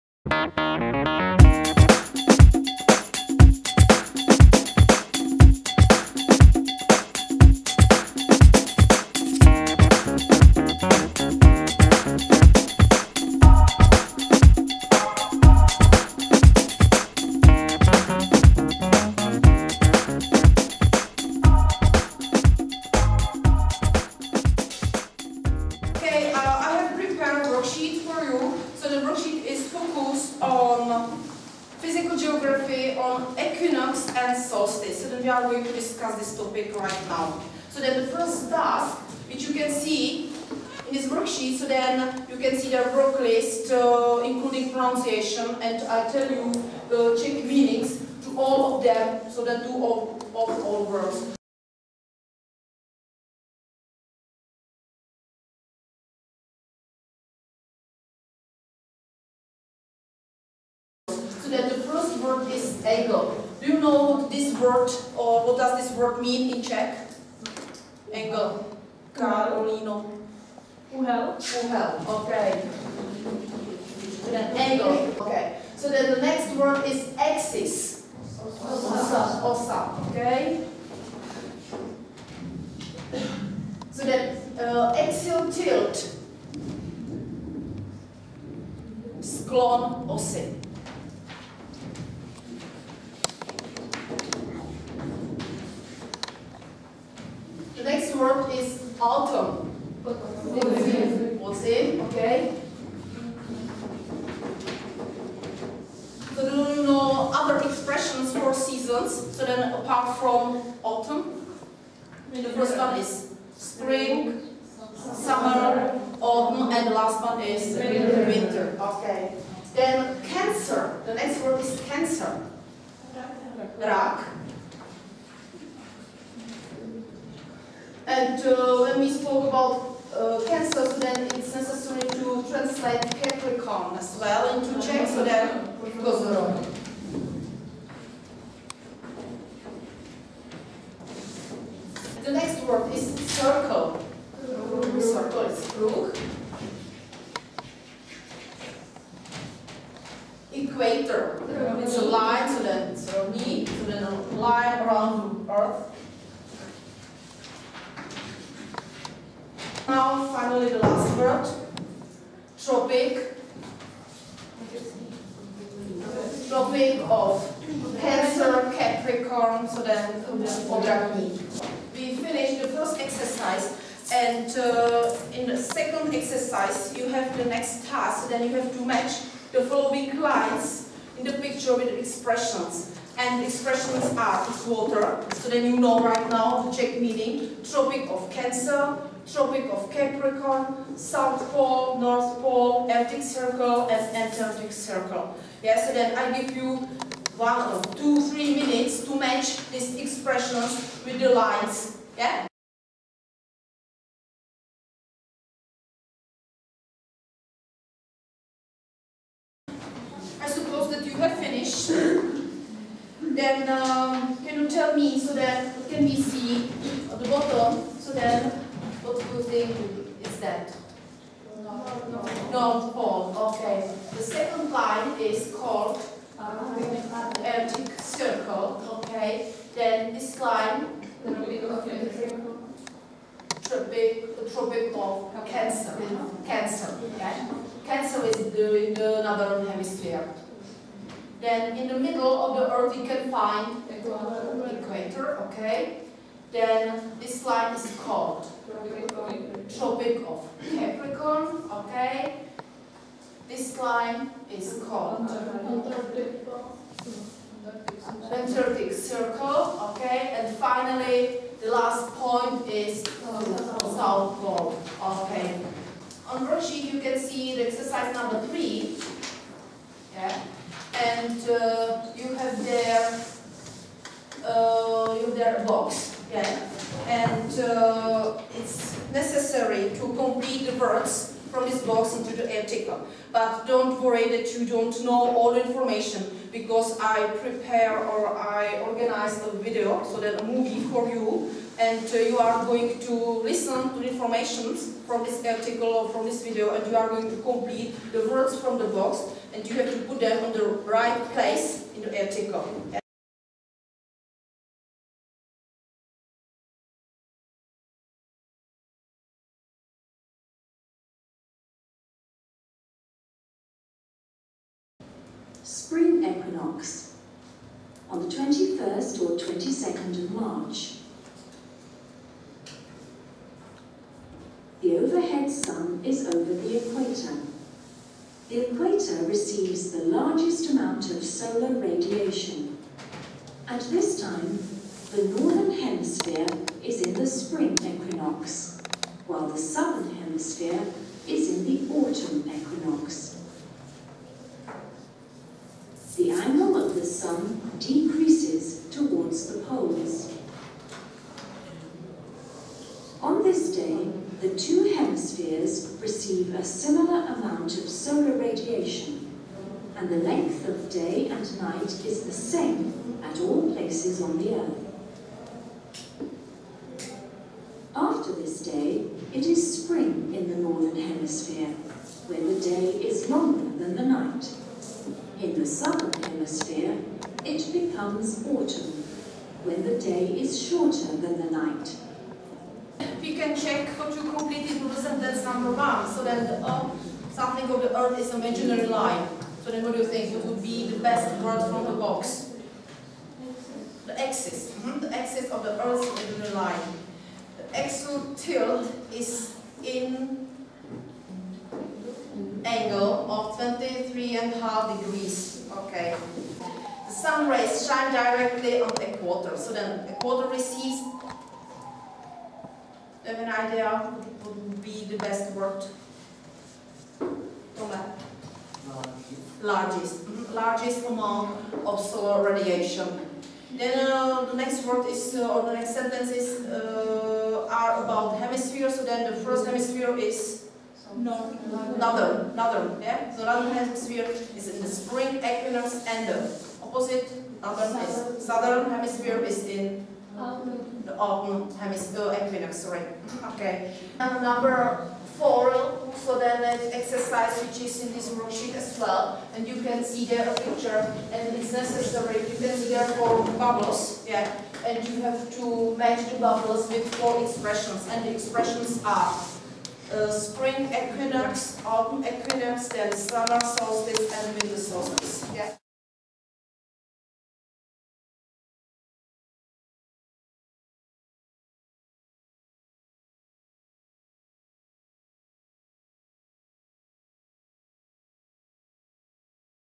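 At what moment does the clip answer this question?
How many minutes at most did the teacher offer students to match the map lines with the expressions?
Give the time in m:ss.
3:18.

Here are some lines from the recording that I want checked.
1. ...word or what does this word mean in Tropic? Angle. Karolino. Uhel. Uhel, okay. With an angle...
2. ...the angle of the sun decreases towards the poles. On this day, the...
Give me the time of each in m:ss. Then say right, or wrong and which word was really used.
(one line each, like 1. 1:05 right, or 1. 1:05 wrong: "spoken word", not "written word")
1. 1:04 wrong: "Czech", not "Tropic"
2. 5:46 right.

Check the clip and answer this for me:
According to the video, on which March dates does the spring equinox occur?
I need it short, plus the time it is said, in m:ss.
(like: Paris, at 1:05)
21st or 22nd of March, at 5:18.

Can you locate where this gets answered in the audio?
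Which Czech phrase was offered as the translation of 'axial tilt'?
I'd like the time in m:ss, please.
1:29.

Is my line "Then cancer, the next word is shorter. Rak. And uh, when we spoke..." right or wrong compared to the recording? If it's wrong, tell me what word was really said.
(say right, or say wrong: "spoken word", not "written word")
wrong: "cancer", not "shorter".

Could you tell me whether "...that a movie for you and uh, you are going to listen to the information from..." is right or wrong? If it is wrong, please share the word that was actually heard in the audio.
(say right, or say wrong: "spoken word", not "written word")
right.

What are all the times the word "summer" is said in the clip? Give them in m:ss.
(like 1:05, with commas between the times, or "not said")
1:55, 6:15, 7:43.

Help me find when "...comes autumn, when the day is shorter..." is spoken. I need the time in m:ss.
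6:18.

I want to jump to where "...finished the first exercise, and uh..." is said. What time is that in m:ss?
2:52.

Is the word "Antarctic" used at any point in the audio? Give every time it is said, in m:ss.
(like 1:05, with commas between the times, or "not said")
3:14, 4:18.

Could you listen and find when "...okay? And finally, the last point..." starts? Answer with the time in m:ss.
4:19.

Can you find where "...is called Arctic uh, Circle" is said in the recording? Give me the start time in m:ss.
3:45.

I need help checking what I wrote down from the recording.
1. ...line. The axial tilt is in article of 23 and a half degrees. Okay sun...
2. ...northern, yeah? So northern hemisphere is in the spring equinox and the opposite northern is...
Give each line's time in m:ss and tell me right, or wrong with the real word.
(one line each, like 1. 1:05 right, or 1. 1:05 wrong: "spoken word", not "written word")
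1. 6:36 wrong: "angle", not "article"
2. 7:12 right.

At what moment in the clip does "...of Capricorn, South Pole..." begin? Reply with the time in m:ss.
3:09.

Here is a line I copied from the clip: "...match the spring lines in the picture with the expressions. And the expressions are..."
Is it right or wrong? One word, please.
wrong.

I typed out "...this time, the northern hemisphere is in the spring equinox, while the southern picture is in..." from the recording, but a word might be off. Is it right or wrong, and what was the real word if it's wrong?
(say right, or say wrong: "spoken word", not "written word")
wrong: "hemisphere", not "picture".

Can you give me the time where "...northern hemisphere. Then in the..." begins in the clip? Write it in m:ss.
3:59.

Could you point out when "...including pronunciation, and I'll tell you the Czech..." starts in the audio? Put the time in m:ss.
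0:44.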